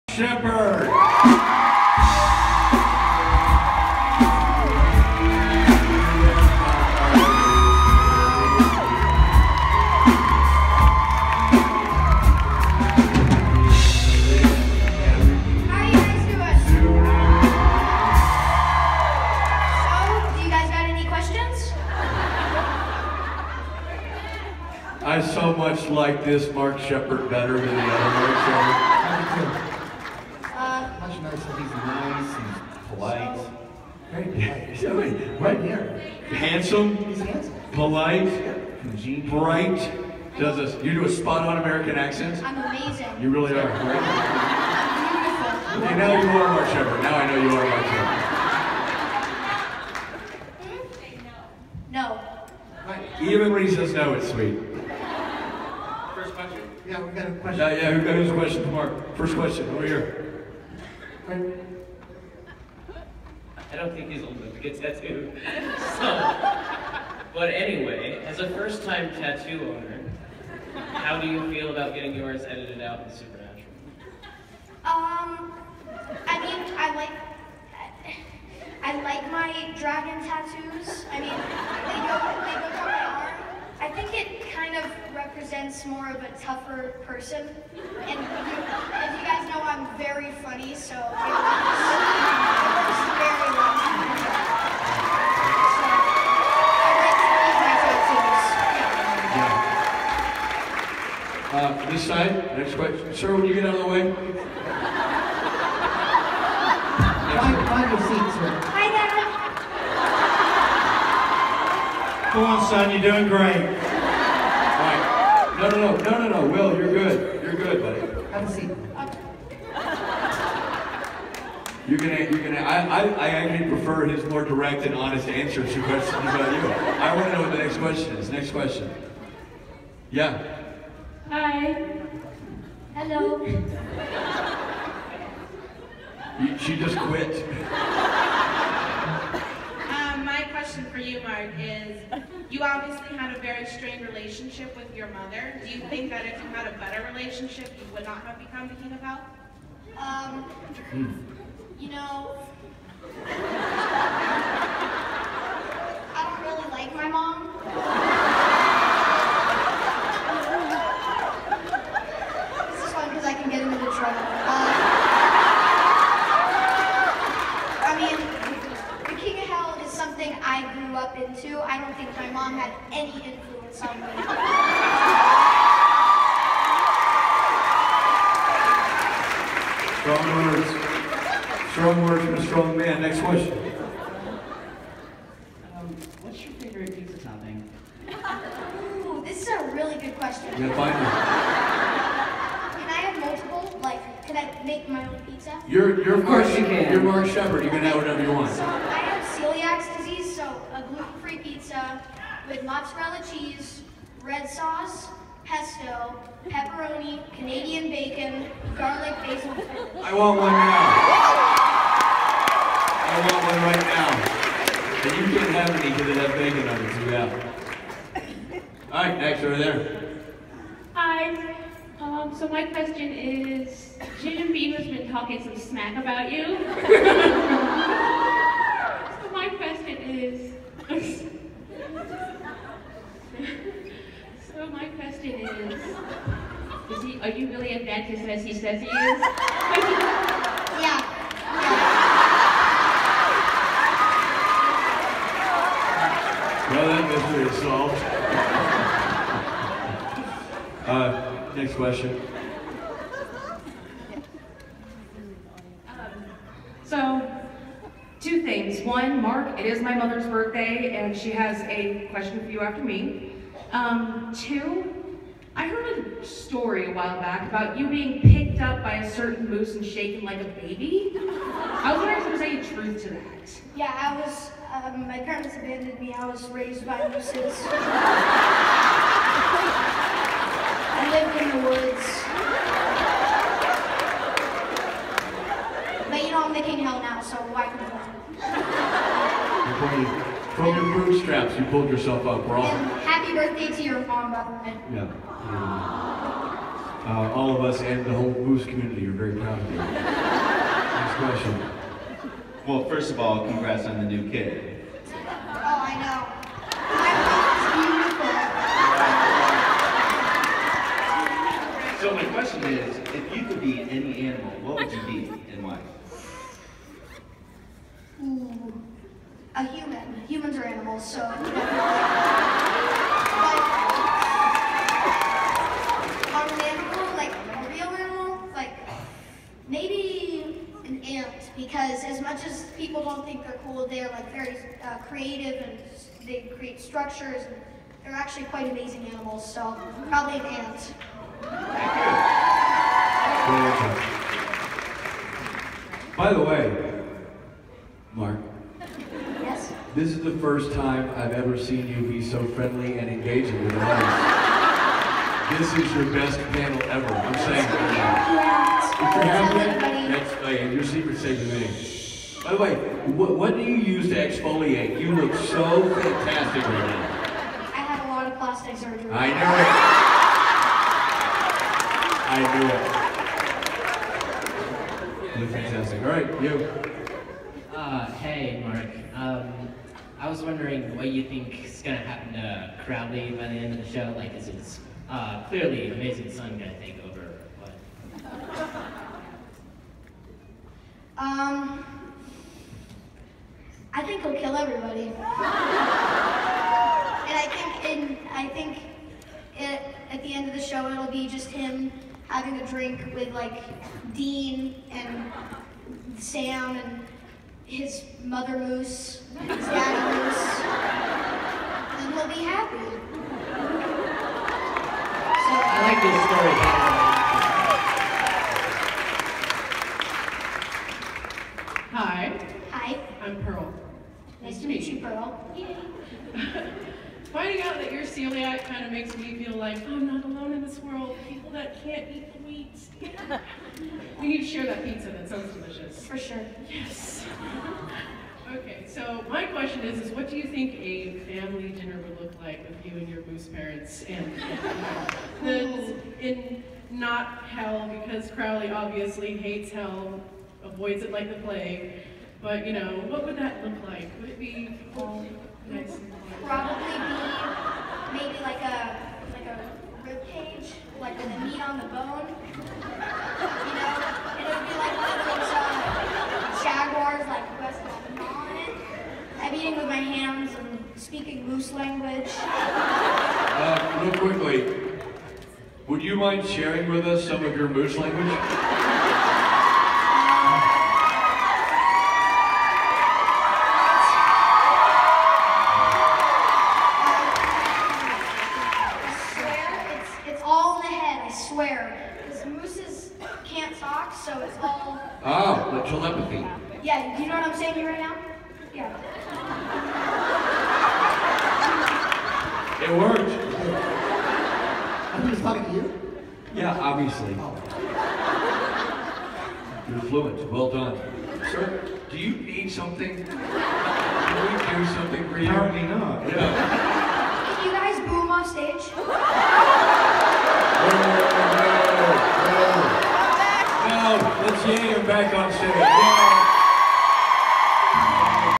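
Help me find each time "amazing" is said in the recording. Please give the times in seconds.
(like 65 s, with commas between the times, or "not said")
42 s, 338 s, 385 s.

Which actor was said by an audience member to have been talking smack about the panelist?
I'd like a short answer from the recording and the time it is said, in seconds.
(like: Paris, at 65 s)
Jim Beaver, at 224 s.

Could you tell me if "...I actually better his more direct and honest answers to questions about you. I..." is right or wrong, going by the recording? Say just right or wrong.
wrong.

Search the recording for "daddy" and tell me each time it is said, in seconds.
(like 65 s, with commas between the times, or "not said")
409 s.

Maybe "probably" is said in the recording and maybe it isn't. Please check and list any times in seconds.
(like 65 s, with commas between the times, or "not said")
340 s, 456 s.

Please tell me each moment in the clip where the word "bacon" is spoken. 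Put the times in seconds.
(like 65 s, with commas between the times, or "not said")
207 s, 216 s.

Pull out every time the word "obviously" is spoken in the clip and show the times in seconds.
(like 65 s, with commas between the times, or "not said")
142 s, 448 s, 506 s.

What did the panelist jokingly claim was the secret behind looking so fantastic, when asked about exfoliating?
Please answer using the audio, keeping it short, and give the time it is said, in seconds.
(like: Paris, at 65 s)
Plastic surgery, at 368 s.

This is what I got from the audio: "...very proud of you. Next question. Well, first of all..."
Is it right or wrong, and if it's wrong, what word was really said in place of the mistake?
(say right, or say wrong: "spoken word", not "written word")
right.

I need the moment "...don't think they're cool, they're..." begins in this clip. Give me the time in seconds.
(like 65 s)
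333 s.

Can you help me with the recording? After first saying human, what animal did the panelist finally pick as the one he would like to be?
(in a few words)
An ant.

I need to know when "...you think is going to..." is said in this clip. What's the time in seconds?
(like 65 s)
381 s.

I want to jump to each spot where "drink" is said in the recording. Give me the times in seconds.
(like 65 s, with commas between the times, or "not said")
402 s.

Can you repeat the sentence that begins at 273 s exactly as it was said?
Yeah, I was, um, my parents abandoned me.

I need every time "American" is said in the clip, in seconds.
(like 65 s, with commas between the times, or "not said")
41 s.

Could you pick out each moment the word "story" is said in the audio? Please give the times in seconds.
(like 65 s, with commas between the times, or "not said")
266 s, 416 s.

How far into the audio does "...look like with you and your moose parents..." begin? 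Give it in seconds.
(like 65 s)
442 s.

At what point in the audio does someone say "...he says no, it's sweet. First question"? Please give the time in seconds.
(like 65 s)
53 s.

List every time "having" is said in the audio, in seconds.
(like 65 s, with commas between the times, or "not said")
359 s, 402 s.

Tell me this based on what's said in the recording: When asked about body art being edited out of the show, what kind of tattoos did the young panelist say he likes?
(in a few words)
Dragon tattoos.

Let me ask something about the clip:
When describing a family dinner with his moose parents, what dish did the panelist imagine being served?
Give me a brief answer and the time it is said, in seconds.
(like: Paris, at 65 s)
A rib cage, at 459 s.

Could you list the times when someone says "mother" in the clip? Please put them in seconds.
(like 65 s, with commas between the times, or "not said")
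145 s, 259 s, 408 s.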